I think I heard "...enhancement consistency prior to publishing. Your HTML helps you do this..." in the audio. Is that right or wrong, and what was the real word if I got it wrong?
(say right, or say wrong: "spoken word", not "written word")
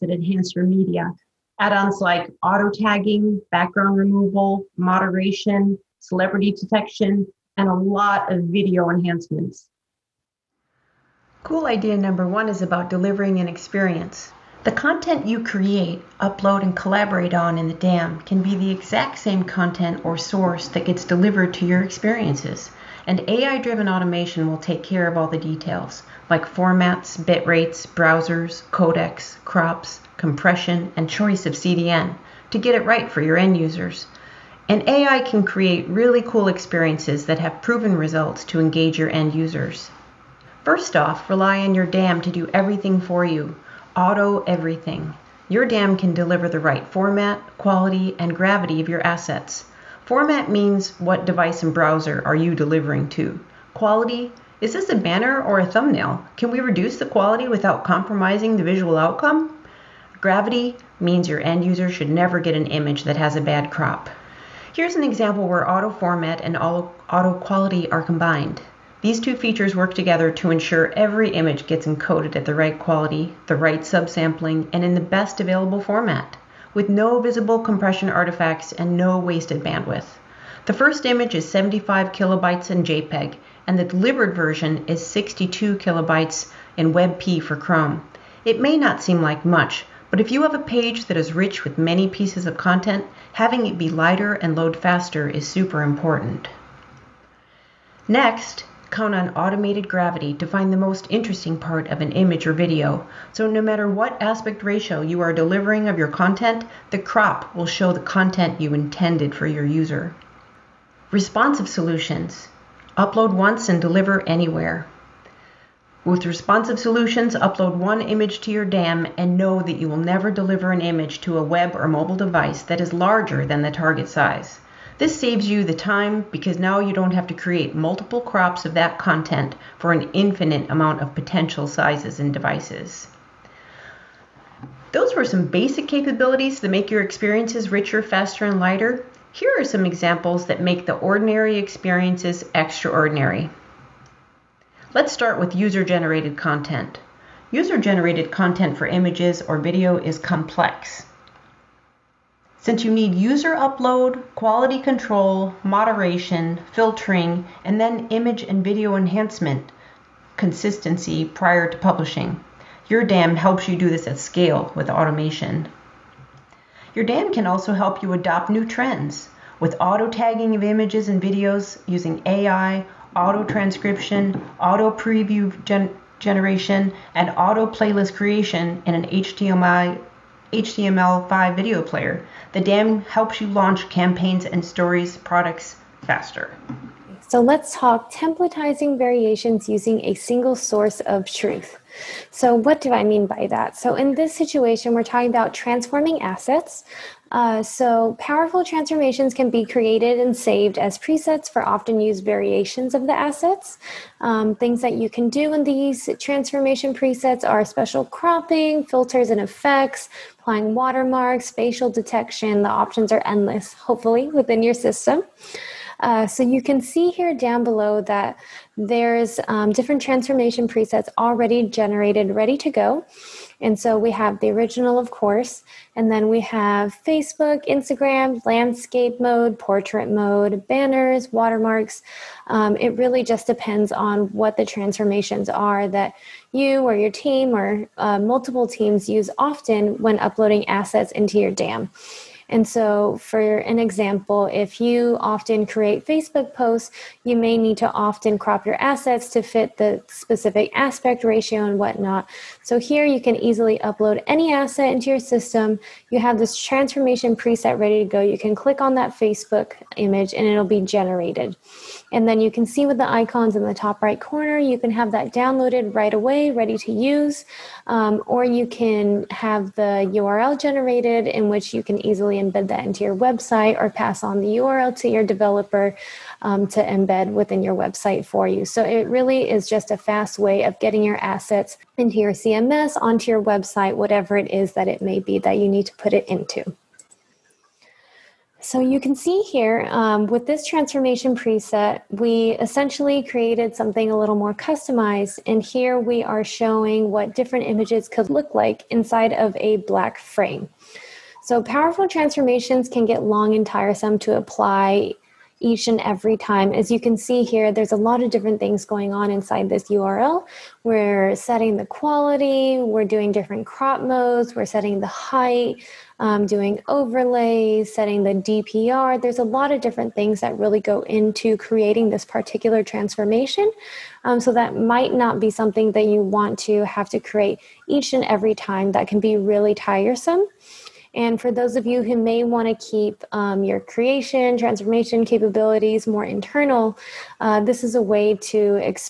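wrong: "DAM", not "HTML".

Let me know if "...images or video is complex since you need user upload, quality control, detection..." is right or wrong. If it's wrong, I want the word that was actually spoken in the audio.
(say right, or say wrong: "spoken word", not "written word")
wrong: "moderation", not "detection".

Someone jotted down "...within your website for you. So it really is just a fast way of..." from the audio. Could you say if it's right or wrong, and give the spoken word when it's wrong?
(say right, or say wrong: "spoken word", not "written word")
right.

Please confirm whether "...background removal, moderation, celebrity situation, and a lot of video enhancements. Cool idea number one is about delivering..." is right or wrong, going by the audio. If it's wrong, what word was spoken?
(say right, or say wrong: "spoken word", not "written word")
wrong: "detection", not "situation".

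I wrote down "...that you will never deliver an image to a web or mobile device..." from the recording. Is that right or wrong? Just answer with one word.
right.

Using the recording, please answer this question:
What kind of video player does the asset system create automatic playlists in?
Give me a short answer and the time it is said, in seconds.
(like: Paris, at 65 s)
HTML5 video player, at 180 s.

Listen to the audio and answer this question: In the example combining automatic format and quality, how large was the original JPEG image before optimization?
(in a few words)
75 kilobytes.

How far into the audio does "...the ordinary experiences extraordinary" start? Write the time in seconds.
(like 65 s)
140 s.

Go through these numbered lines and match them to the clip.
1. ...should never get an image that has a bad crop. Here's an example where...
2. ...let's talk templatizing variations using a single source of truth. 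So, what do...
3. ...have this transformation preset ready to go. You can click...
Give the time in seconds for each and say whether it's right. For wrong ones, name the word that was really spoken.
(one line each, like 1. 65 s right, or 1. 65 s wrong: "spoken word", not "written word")
1. 61 s right
2. 187 s right
3. 256 s right.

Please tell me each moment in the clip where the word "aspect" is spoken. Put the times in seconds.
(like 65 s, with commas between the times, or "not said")
104 s, 250 s.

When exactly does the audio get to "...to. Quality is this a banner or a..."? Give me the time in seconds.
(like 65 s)
53 s.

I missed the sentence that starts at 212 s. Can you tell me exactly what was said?
The options are endless, hopefully, within your system.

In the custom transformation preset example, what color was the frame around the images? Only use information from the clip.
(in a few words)
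black.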